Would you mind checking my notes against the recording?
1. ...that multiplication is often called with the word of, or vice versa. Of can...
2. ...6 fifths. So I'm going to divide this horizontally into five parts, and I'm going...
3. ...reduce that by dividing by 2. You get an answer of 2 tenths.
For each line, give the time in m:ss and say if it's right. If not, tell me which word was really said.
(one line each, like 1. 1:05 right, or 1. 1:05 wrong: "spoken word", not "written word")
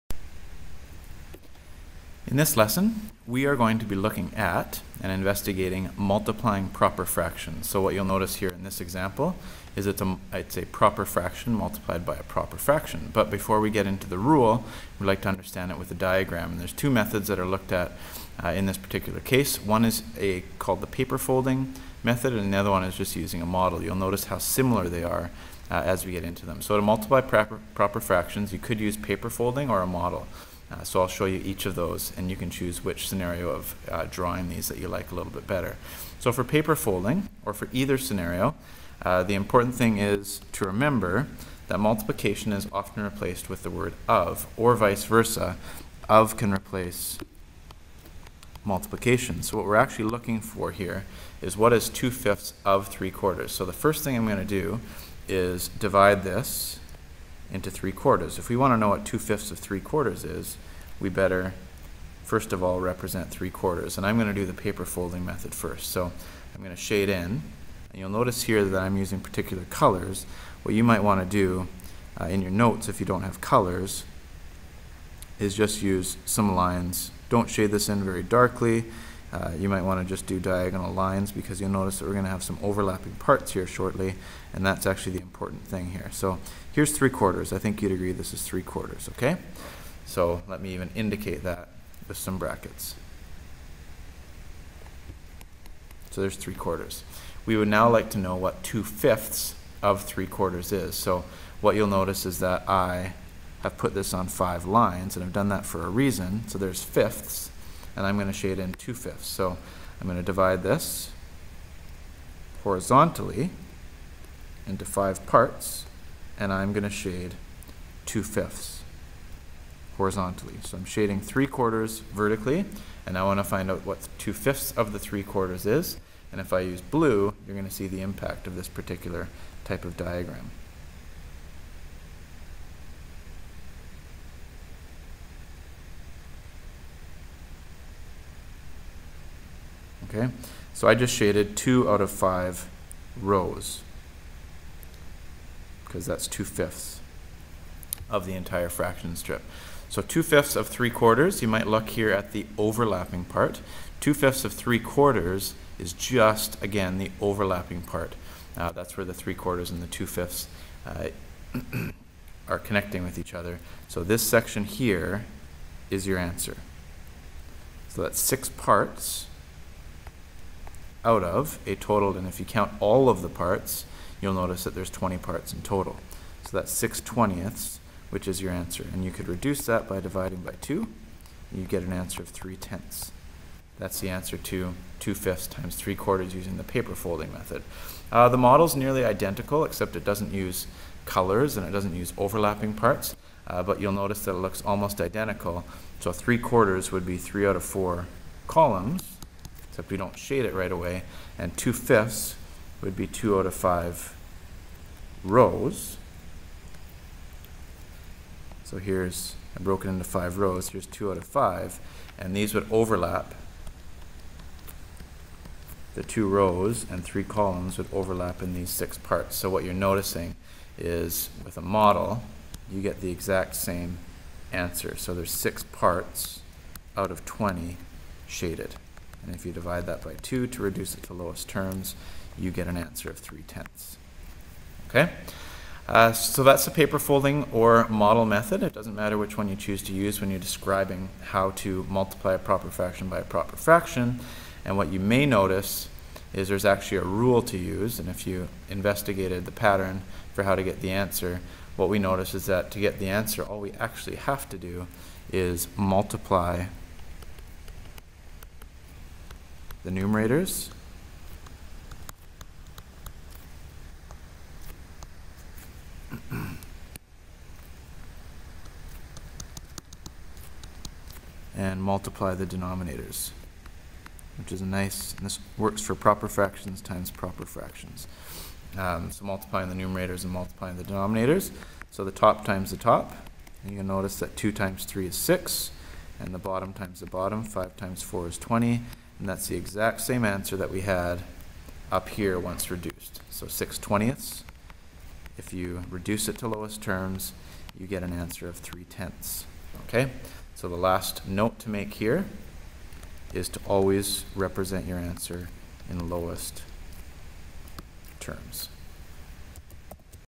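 1. 0:41 wrong: "replaced", not "called"
2. 1:48 wrong: "2", not "6"
3. 2:59 wrong: "3", not "2".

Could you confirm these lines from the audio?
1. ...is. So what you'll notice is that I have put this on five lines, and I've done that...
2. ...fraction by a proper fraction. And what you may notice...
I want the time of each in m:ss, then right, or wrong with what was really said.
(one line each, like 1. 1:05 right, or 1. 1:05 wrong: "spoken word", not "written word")
1. 1:40 right
2. 4:02 right.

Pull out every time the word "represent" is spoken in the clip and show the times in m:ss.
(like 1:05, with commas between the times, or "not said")
1:02, 5:04.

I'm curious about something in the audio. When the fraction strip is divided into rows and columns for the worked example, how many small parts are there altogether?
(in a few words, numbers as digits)
20.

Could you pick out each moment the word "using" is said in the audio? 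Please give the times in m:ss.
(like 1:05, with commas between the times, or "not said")
0:23, 1:08, 3:06.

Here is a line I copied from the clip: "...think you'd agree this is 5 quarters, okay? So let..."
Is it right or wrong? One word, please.
wrong.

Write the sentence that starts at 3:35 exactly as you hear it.
The two rows and three columns would overlap in these six parts.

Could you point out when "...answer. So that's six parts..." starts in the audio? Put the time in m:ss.
2:46.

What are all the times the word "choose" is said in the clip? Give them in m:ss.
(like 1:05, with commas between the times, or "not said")
0:32, 3:59.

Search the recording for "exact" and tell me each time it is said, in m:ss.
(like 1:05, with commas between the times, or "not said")
3:43, 4:49.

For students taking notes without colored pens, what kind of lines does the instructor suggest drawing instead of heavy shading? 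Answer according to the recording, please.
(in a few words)
diagonal lines.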